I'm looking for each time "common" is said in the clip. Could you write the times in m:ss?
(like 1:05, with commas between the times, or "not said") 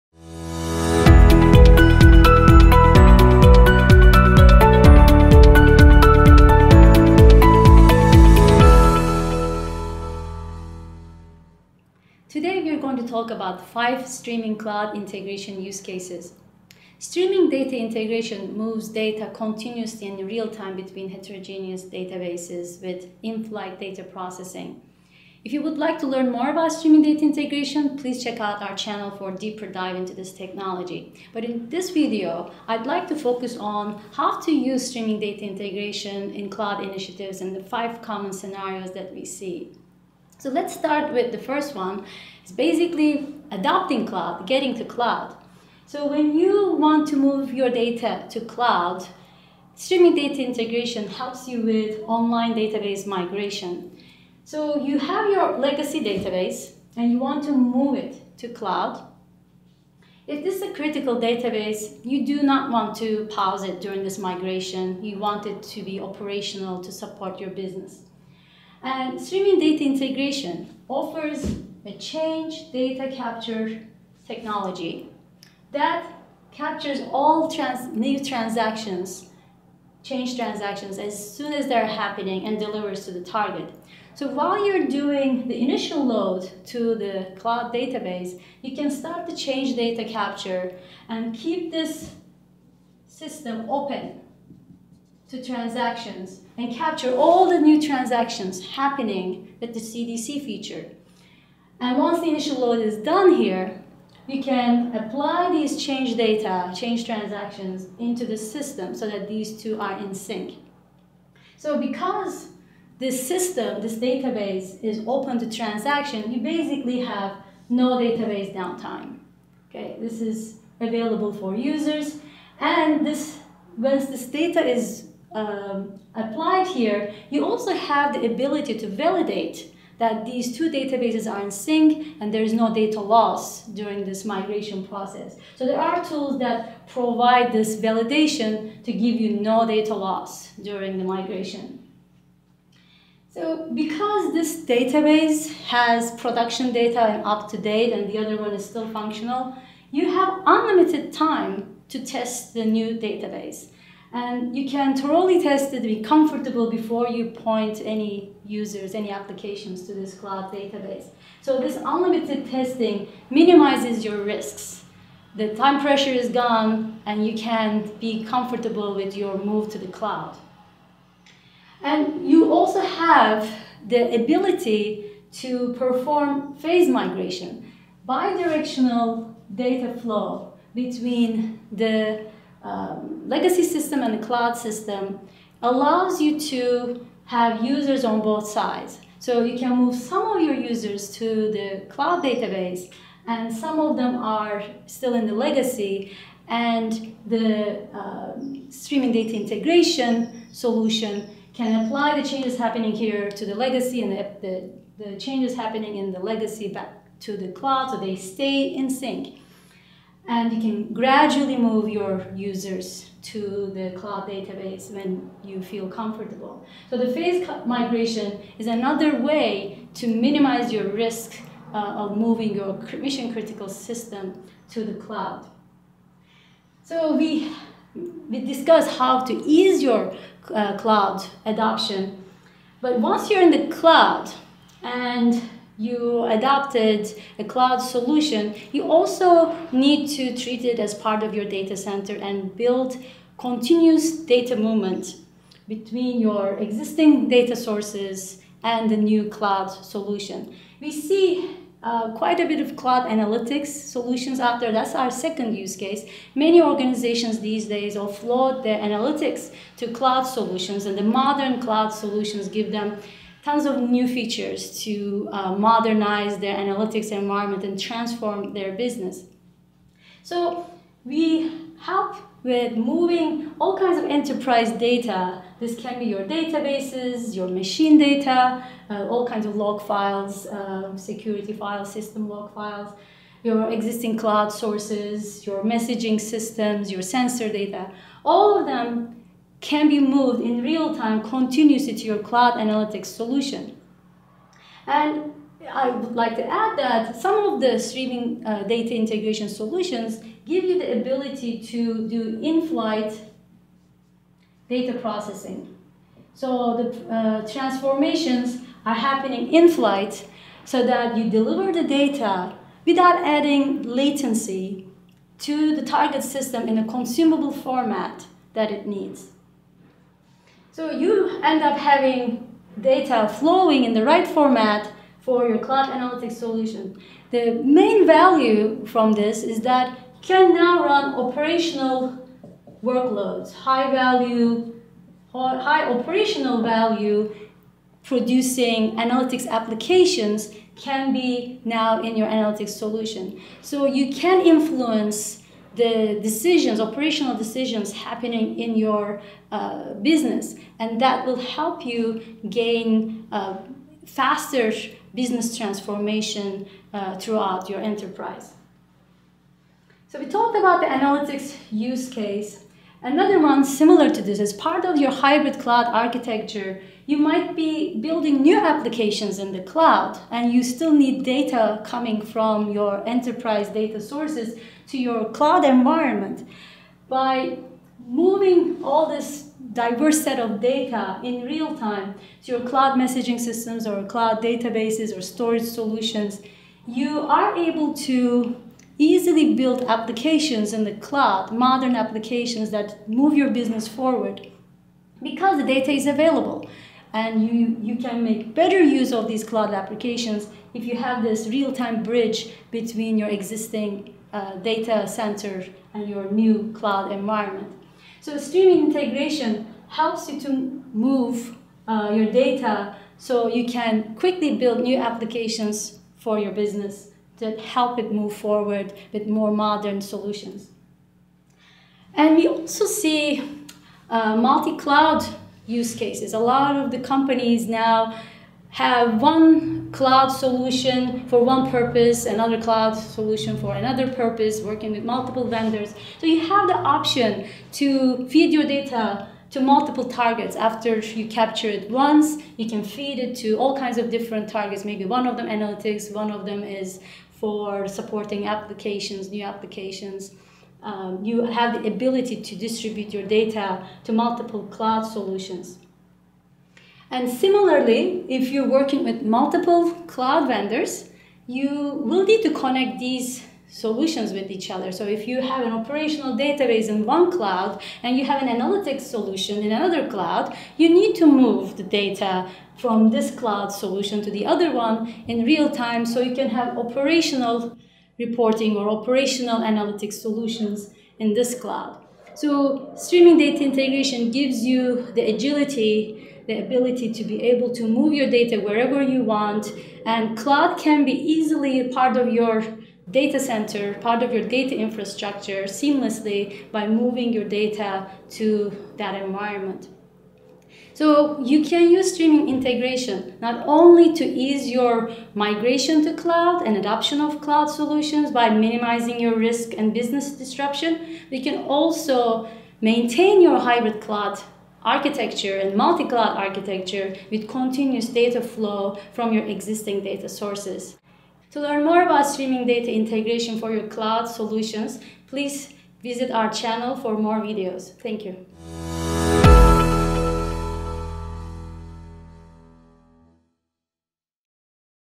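0:38.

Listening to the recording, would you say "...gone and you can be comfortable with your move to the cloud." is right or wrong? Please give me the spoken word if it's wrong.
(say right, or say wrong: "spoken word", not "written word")
right.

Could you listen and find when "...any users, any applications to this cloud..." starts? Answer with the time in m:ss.
2:37.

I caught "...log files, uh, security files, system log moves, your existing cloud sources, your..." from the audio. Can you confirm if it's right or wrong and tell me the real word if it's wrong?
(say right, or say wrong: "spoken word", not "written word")
wrong: "files", not "moves".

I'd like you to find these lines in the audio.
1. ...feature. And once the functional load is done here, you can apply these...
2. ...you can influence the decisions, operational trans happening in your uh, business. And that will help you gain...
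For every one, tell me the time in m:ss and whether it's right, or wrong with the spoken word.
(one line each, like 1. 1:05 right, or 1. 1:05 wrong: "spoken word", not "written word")
1. 1:40 wrong: "initial", not "functional"
2. 5:43 wrong: "decisions", not "trans".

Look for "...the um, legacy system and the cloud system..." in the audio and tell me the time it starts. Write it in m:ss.
3:01.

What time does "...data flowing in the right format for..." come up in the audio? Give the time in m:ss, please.
5:22.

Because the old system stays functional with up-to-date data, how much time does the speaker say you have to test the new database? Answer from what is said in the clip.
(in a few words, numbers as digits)
unlimited time.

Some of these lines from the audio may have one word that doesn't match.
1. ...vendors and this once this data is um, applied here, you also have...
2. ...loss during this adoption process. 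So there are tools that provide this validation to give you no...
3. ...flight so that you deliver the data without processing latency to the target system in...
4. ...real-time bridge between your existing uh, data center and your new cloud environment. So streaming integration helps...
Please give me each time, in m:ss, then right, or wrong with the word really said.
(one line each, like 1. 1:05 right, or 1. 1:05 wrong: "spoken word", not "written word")
1. 2:01 wrong: "users", not "vendors"
2. 2:12 wrong: "migration", not "adoption"
3. 5:09 wrong: "adding", not "processing"
4. 6:41 right.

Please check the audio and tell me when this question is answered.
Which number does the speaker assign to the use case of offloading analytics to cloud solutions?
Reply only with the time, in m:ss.
4:15.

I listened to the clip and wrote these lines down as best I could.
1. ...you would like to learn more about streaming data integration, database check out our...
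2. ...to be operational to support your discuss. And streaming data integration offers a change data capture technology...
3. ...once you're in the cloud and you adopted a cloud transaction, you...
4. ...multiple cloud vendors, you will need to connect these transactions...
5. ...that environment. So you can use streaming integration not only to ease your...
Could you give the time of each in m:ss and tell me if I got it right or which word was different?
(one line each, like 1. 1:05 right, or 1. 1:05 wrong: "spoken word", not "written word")
1. 0:25 wrong: "please", not "database"
2. 1:05 wrong: "business", not "discuss"
3. 3:52 wrong: "solution", not "transaction"
4. 7:39 wrong: "solutions", not "transactions"
5. 8:18 right.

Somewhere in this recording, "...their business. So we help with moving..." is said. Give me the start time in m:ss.
4:28.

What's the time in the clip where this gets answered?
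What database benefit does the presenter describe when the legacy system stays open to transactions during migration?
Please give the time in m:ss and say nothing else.
1:57.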